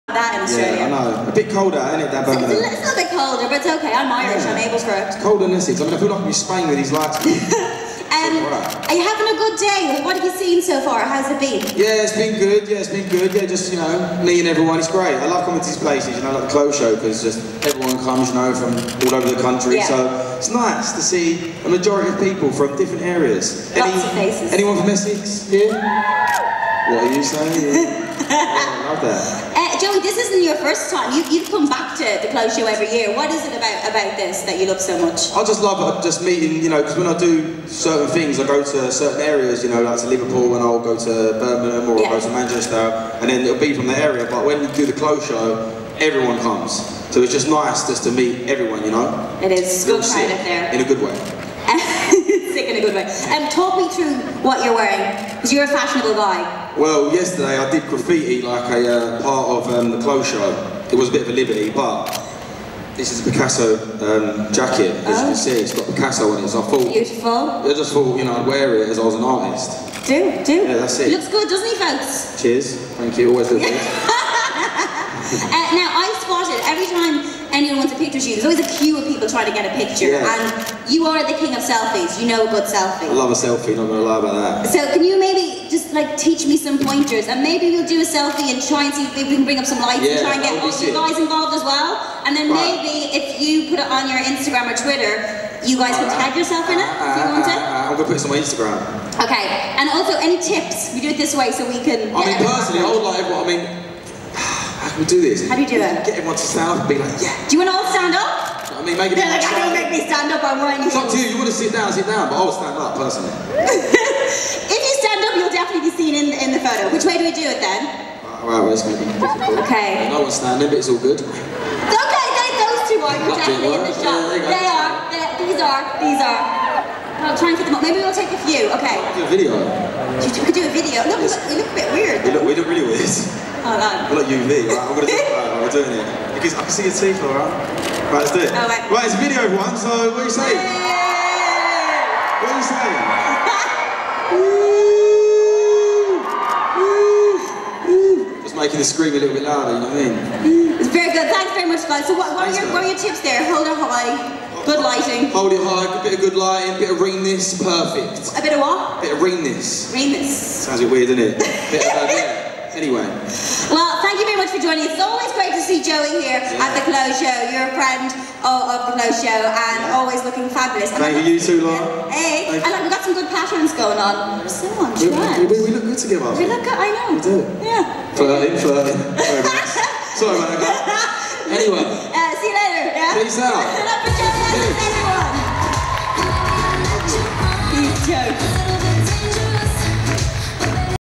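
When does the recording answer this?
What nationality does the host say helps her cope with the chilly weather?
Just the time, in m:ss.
0:03.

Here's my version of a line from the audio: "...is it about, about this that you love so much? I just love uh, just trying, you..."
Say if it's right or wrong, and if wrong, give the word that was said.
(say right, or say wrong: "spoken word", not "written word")
wrong: "meeting", not "trying".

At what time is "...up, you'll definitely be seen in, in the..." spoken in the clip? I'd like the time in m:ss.
1:55.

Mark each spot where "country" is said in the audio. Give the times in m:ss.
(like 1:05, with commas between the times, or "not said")
0:19.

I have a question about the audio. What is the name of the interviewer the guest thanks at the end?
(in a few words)
Laura.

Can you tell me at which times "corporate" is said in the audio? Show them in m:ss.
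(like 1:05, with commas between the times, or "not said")
not said.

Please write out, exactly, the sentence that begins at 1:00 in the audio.
It was a bit of a liberty, but this is a Picasso um, jacket, as oh.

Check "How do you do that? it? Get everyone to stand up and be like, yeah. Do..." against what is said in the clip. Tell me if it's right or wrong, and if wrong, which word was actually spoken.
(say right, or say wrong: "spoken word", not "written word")
right.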